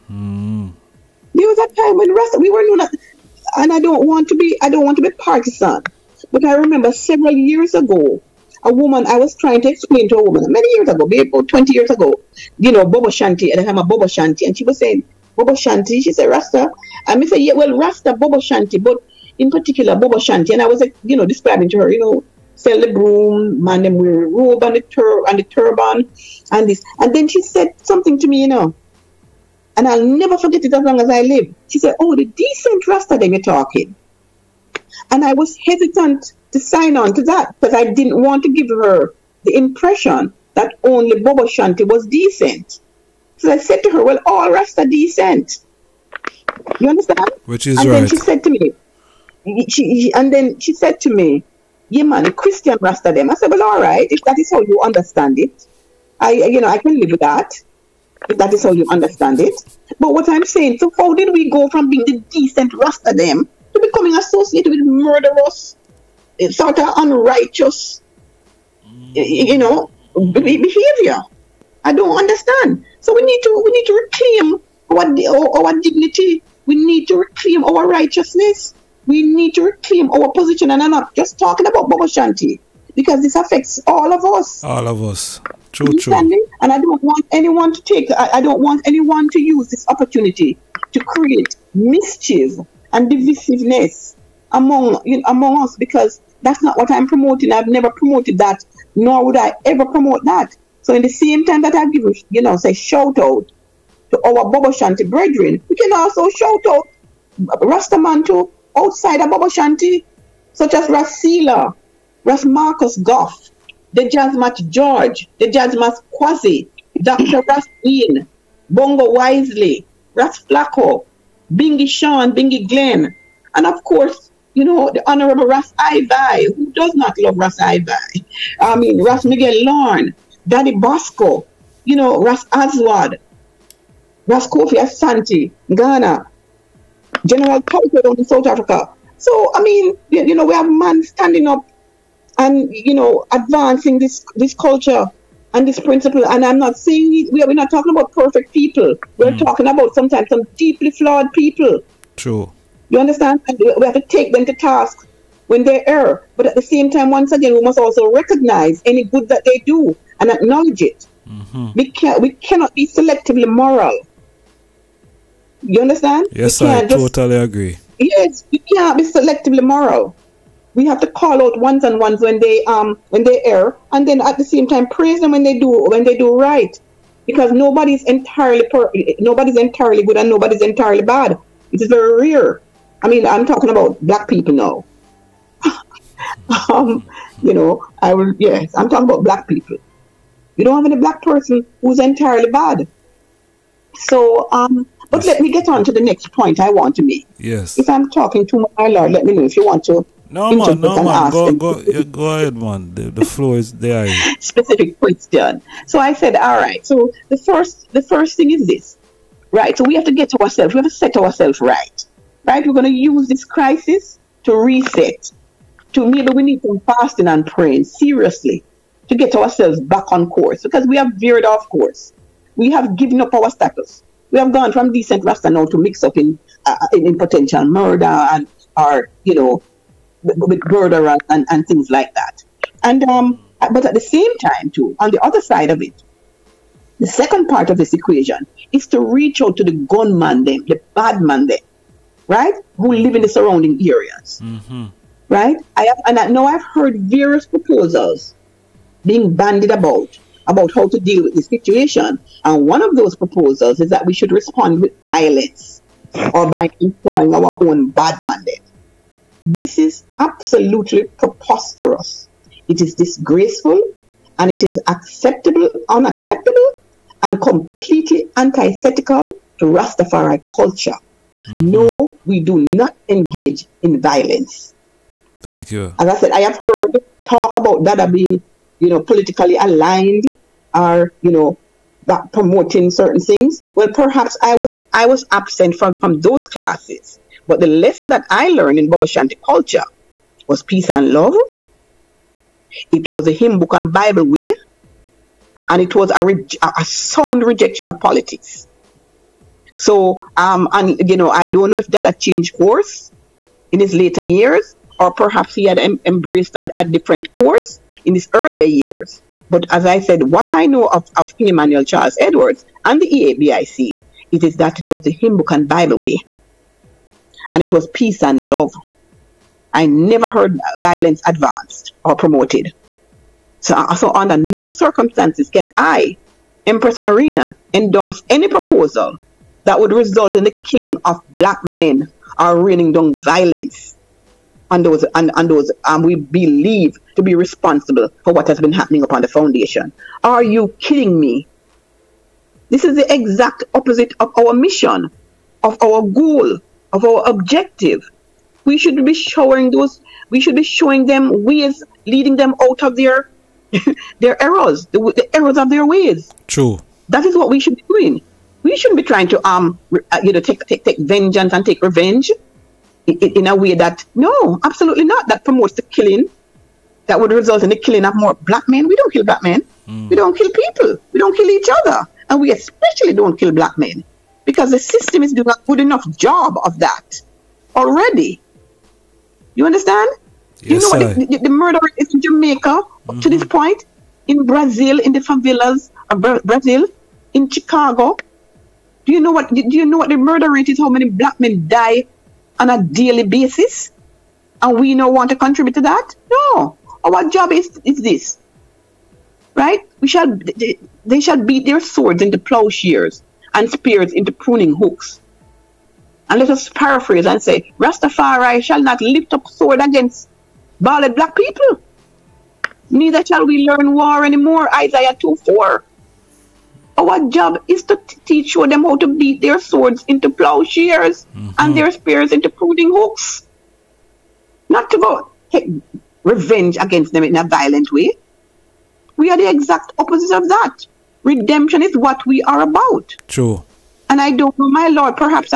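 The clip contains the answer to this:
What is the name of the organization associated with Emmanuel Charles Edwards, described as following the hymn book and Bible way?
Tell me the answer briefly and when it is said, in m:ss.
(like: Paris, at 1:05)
EABIC, at 5:13.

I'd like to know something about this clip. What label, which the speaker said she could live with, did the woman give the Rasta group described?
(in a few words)
Christian Rasta.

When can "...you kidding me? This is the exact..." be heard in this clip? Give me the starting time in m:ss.
5:40.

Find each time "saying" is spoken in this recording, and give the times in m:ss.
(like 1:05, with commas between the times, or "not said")
0:14, 1:00, 2:26.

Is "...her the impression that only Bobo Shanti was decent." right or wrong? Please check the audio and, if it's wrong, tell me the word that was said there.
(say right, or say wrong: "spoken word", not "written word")
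right.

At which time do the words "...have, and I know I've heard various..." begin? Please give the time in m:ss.
4:05.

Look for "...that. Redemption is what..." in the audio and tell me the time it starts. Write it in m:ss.
7:10.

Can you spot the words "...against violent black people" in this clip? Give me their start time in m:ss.
6:49.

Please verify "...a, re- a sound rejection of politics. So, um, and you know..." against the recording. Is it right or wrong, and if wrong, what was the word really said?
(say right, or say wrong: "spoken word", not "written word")
right.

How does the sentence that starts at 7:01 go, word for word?
and their spears into pruning hooks.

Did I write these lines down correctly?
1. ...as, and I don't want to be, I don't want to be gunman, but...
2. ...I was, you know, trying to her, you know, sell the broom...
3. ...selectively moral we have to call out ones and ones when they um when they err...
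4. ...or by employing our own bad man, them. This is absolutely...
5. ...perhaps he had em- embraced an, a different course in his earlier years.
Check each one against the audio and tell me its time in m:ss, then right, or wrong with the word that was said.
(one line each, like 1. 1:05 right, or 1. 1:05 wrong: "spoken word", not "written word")
1. 0:02 wrong: "partisan", not "gunman"
2. 0:20 wrong: "describing", not "trying"
3. 2:49 right
4. 4:16 right
5. 5:05 right.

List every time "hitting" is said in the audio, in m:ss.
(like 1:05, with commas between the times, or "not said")
not said.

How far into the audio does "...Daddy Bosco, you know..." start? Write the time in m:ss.
2:10.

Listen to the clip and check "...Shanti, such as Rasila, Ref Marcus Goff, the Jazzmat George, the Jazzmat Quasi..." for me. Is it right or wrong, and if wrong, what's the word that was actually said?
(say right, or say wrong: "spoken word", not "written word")
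right.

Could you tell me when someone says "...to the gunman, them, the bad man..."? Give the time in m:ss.
3:59.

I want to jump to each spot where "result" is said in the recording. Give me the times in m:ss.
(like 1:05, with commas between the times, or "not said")
5:29, 6:07.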